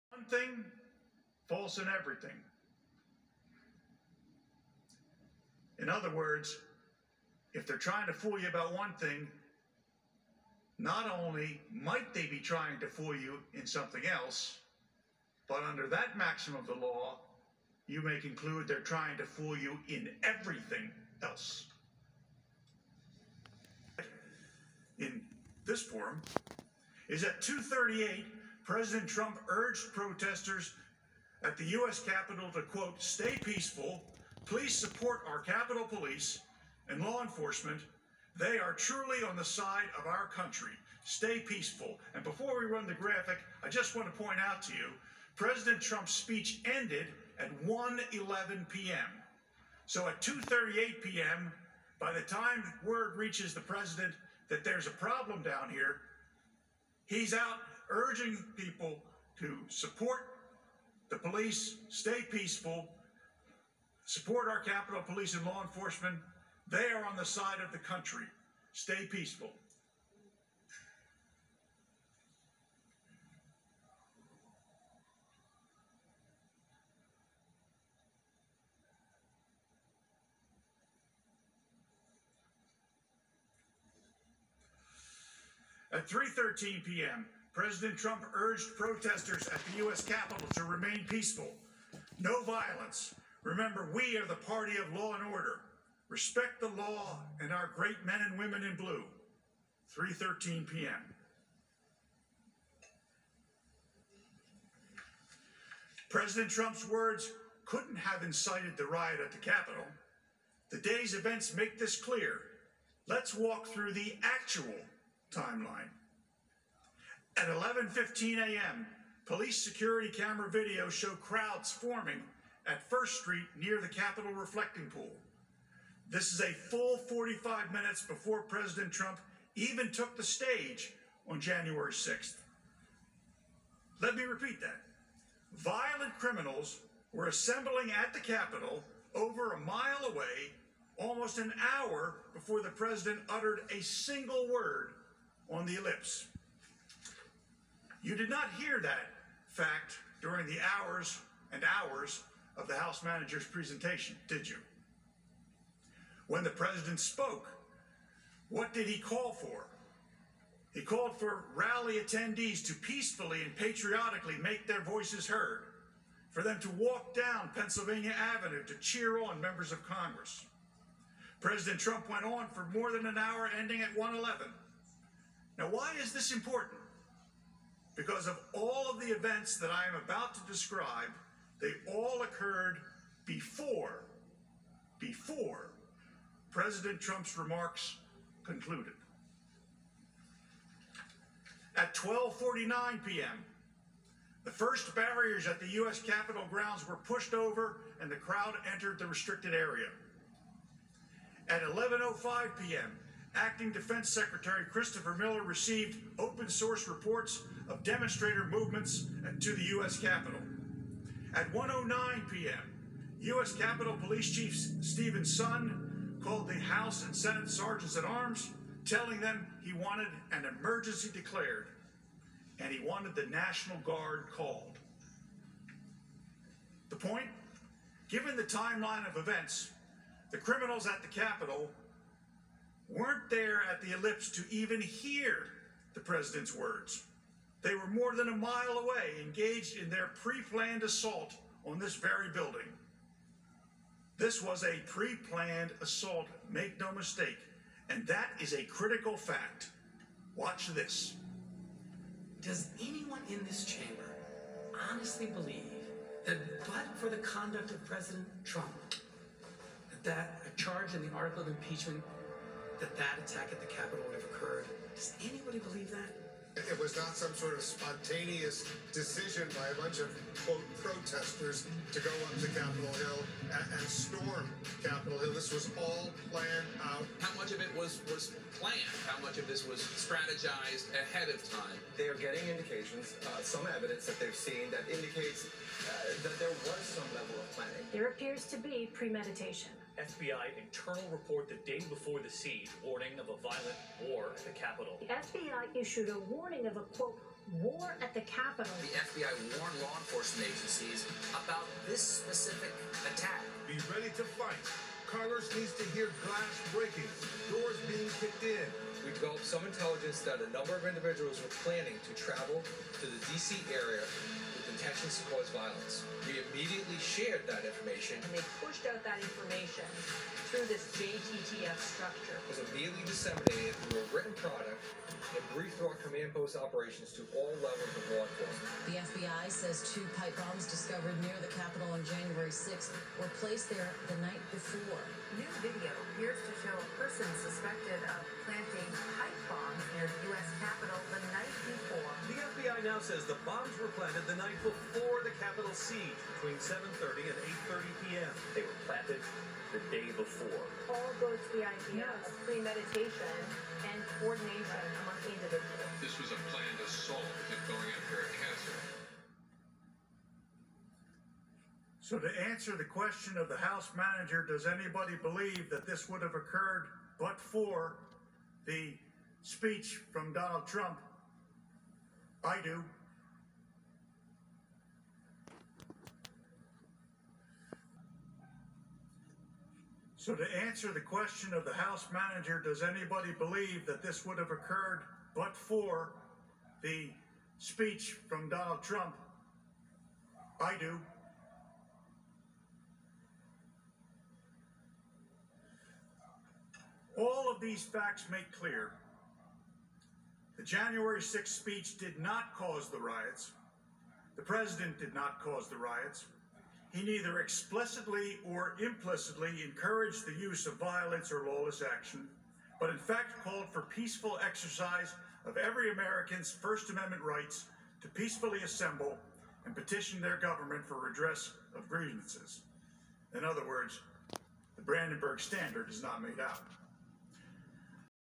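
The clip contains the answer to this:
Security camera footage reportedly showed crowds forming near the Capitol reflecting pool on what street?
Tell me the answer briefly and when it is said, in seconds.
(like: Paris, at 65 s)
First Street, at 122 s.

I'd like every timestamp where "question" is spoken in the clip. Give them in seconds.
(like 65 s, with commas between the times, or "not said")
362 s, 380 s.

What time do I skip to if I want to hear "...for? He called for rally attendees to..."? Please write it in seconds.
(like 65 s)
159 s.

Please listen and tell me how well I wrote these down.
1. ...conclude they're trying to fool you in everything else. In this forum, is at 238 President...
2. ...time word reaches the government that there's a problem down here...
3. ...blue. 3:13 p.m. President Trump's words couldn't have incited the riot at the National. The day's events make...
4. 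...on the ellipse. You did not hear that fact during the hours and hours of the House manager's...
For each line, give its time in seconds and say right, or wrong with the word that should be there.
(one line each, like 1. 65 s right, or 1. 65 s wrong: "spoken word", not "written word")
1. 18 s right
2. 52 s wrong: "president", not "government"
3. 98 s wrong: "Capitol", not "National"
4. 145 s right.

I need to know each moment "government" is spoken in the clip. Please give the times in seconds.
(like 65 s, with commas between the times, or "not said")
420 s.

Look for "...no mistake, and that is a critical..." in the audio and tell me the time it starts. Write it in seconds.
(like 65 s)
246 s.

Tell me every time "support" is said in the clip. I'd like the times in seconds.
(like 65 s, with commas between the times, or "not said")
34 s, 59 s, 64 s.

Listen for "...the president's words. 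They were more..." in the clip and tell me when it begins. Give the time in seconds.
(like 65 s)
235 s.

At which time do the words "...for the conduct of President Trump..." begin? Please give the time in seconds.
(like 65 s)
256 s.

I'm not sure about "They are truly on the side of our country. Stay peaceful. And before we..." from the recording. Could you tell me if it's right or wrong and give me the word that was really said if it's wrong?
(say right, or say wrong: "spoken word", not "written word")
right.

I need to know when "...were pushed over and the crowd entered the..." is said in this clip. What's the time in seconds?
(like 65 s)
196 s.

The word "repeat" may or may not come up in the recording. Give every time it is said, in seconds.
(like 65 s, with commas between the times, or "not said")
134 s.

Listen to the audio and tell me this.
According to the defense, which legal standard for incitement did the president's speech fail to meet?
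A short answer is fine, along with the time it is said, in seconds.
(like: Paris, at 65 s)
Brandenburg Standard, at 424 s.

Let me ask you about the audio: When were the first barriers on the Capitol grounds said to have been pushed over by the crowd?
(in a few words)
12:49 p.m.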